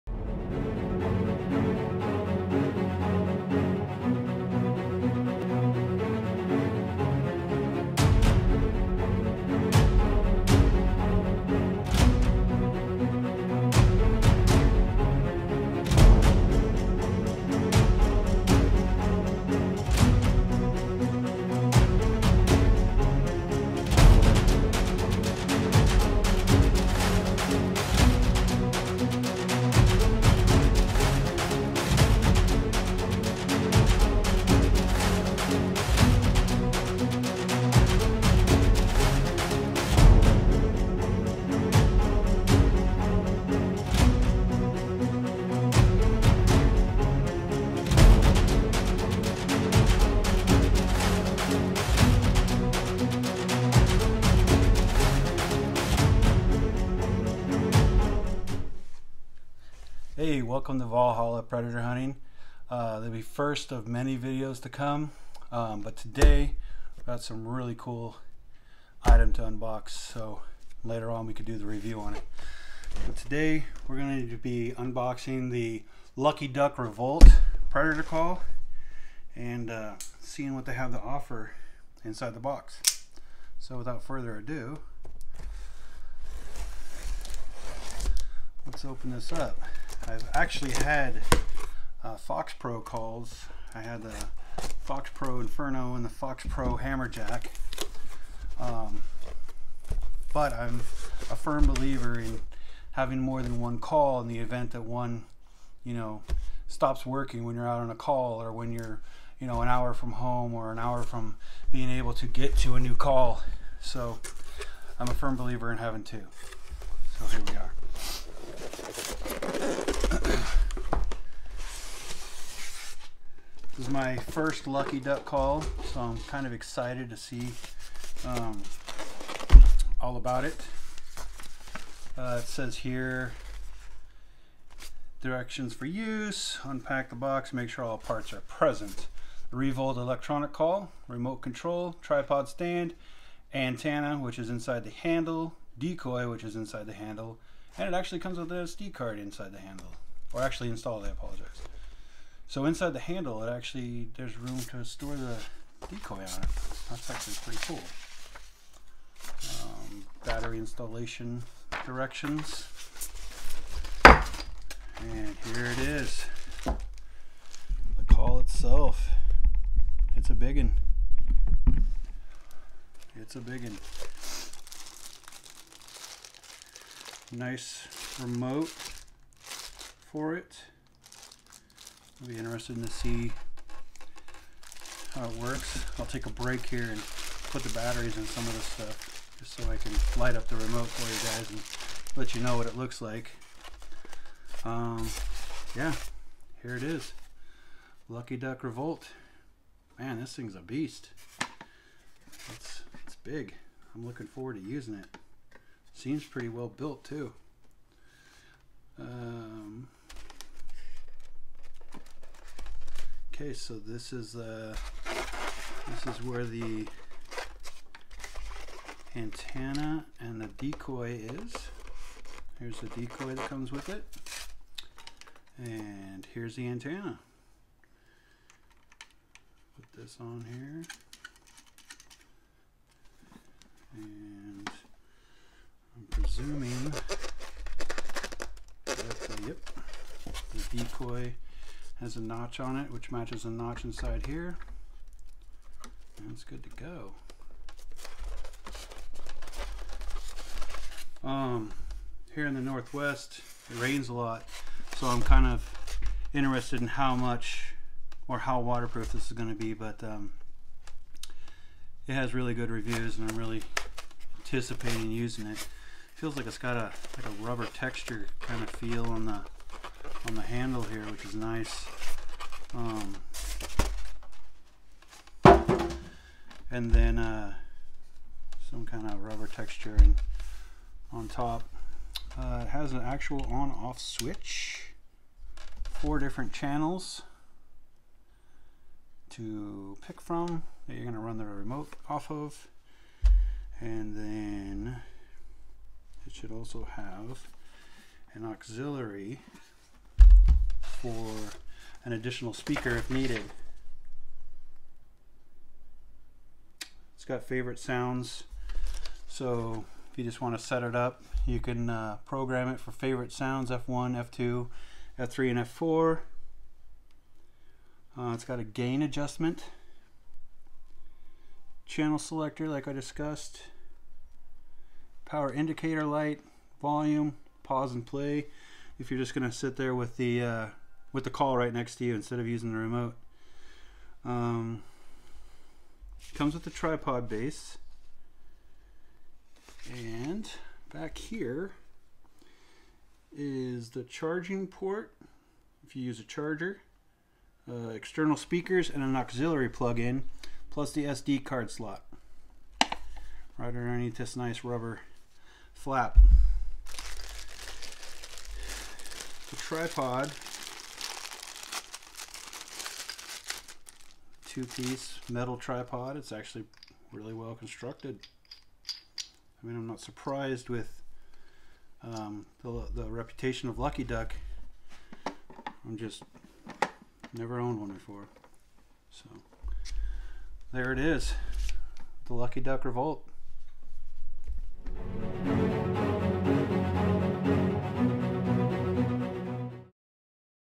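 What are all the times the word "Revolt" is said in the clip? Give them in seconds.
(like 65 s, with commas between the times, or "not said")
76 s, 139 s, 198 s, 382 s.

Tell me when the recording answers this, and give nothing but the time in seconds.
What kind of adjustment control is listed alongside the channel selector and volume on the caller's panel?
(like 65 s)
318 s.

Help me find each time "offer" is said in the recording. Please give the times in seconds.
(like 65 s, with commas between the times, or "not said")
80 s.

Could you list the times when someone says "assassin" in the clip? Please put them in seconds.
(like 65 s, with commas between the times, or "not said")
not said.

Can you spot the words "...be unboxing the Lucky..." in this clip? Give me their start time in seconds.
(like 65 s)
74 s.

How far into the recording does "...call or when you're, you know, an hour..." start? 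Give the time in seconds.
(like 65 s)
107 s.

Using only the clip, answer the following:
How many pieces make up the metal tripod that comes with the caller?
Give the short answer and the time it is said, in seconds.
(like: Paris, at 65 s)
2, at 364 s.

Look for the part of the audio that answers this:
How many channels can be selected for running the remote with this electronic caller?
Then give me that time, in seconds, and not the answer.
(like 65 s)
285 s.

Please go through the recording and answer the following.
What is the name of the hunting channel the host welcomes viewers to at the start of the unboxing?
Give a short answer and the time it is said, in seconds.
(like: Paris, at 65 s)
Valhalla Predator Hunting, at 60 s.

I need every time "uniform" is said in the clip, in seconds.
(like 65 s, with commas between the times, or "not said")
not said.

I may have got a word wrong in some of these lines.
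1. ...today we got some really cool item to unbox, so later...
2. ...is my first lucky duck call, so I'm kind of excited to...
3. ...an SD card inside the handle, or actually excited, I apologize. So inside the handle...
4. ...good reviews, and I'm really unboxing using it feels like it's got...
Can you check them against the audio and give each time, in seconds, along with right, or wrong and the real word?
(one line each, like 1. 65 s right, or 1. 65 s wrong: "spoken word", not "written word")
1. 65 s right
2. 123 s right
3. 148 s wrong: "installed", not "excited"
4. 262 s wrong: "anticipating", not "unboxing".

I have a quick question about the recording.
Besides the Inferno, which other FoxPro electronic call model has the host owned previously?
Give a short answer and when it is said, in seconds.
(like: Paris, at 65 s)
Hammerjack, at 96 s.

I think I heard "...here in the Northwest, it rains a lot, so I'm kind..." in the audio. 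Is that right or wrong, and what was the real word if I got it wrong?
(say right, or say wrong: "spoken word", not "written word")
right.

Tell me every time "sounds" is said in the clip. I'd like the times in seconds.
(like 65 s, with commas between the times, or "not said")
307 s, 313 s.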